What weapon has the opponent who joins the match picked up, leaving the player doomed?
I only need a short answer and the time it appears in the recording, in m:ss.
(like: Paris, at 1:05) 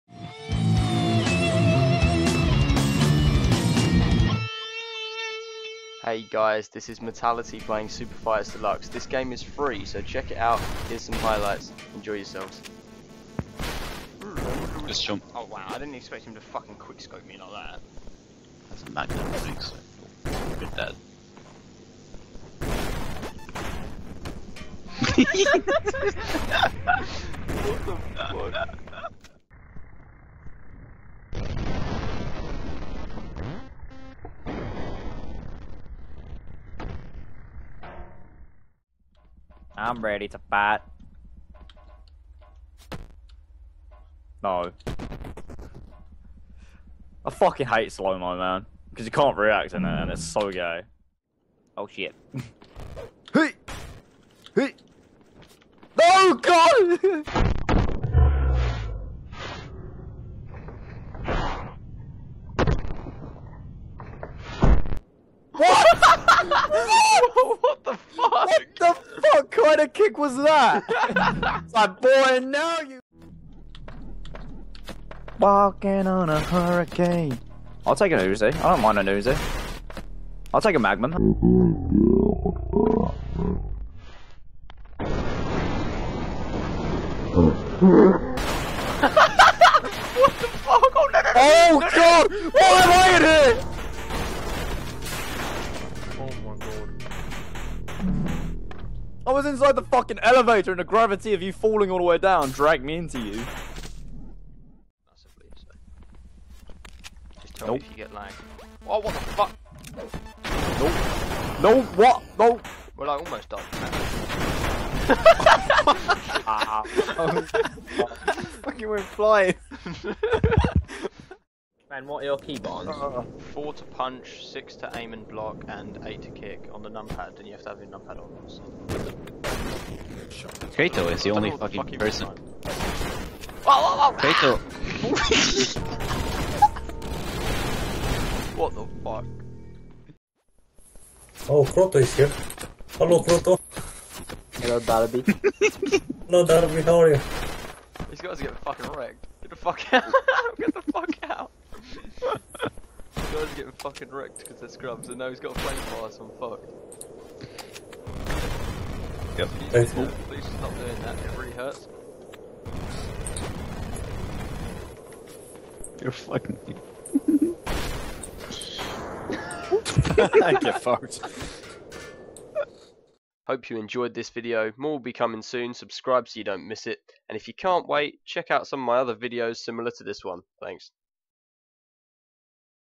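flamethrower, at 2:35.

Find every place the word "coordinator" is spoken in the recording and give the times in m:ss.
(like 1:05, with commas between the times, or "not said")
not said.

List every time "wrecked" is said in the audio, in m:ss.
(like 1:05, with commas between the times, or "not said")
2:28, 2:34.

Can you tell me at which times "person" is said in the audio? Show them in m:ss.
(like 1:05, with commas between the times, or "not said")
2:11.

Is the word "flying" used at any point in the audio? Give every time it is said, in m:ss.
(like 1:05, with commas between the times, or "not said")
1:59.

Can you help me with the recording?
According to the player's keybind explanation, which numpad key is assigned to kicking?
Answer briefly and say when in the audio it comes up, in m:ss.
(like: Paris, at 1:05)
8, at 2:06.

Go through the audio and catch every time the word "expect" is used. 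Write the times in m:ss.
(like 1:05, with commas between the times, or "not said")
0:15.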